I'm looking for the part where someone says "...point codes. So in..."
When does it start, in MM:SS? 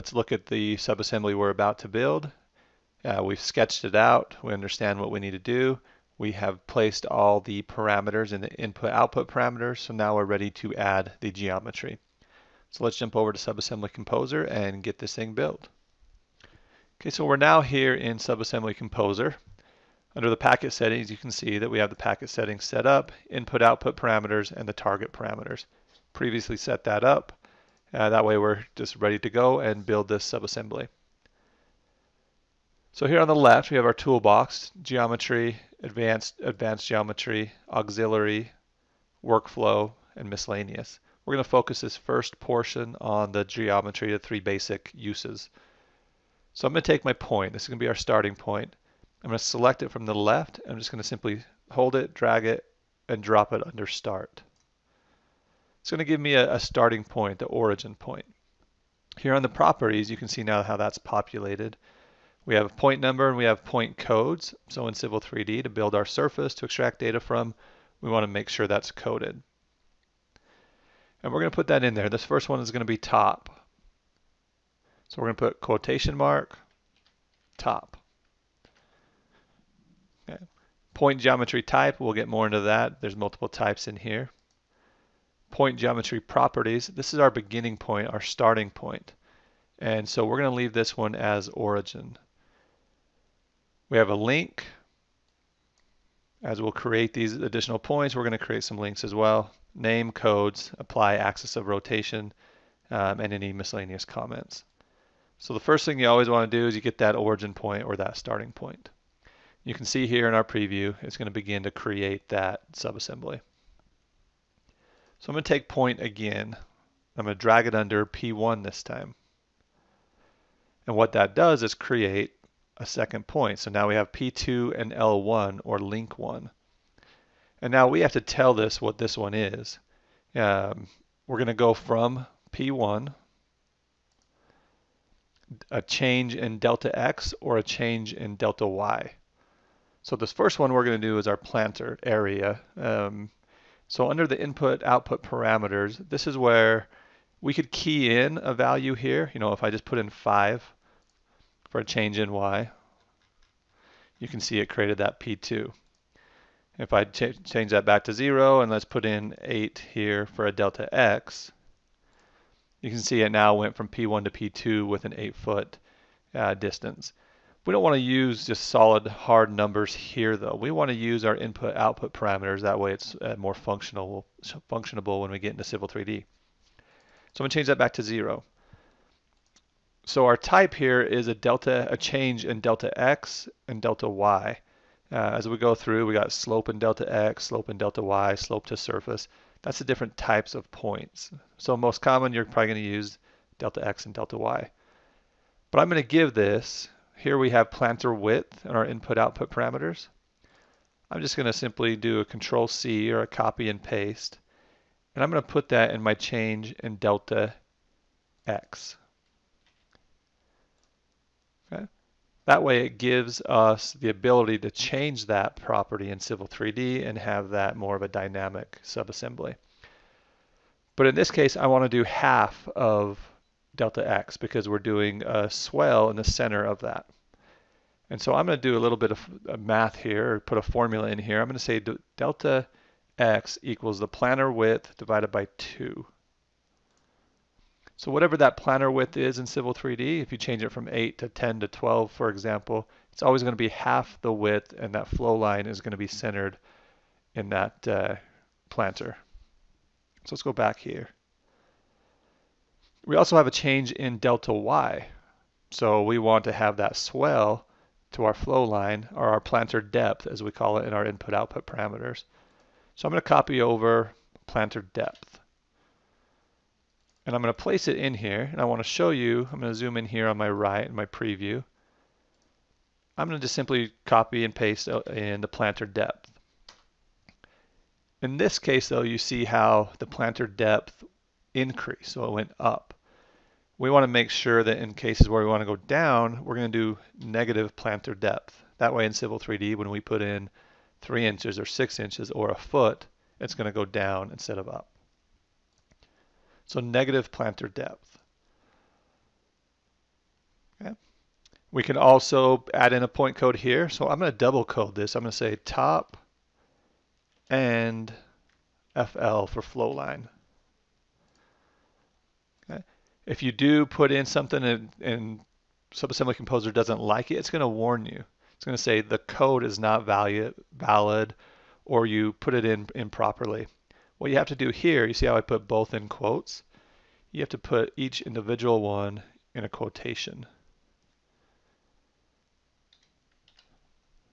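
01:03.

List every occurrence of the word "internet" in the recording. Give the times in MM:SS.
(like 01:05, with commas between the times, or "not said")
not said.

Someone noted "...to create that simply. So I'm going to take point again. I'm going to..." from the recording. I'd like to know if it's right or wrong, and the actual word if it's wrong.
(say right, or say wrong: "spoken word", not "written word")
wrong: "subassembly", not "simply".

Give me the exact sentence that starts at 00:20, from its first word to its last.
Under the packet settings, you can see that we have the packet settings set up, input output parameters, and the target parameters.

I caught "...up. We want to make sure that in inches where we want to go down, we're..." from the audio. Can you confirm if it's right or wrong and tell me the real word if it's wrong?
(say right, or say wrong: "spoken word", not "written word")
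wrong: "cases", not "inches".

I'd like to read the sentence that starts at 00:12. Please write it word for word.
So let's jump over to Subassembly Composer and get this thing built.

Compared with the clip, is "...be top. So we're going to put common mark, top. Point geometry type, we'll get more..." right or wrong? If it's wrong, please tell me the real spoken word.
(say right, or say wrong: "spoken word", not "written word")
wrong: "quotation", not "common".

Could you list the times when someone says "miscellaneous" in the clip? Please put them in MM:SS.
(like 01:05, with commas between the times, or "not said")
00:40, 01:43.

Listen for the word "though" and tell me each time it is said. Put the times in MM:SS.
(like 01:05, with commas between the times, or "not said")
02:50, 04:38.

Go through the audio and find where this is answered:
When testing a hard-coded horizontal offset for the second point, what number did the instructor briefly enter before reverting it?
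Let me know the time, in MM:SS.
02:38.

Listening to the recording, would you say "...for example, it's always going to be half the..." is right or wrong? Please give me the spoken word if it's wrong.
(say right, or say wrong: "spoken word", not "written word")
right.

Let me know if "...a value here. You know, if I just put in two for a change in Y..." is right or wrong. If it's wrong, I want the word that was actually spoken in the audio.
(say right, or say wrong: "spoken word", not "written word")
wrong: "five", not "two".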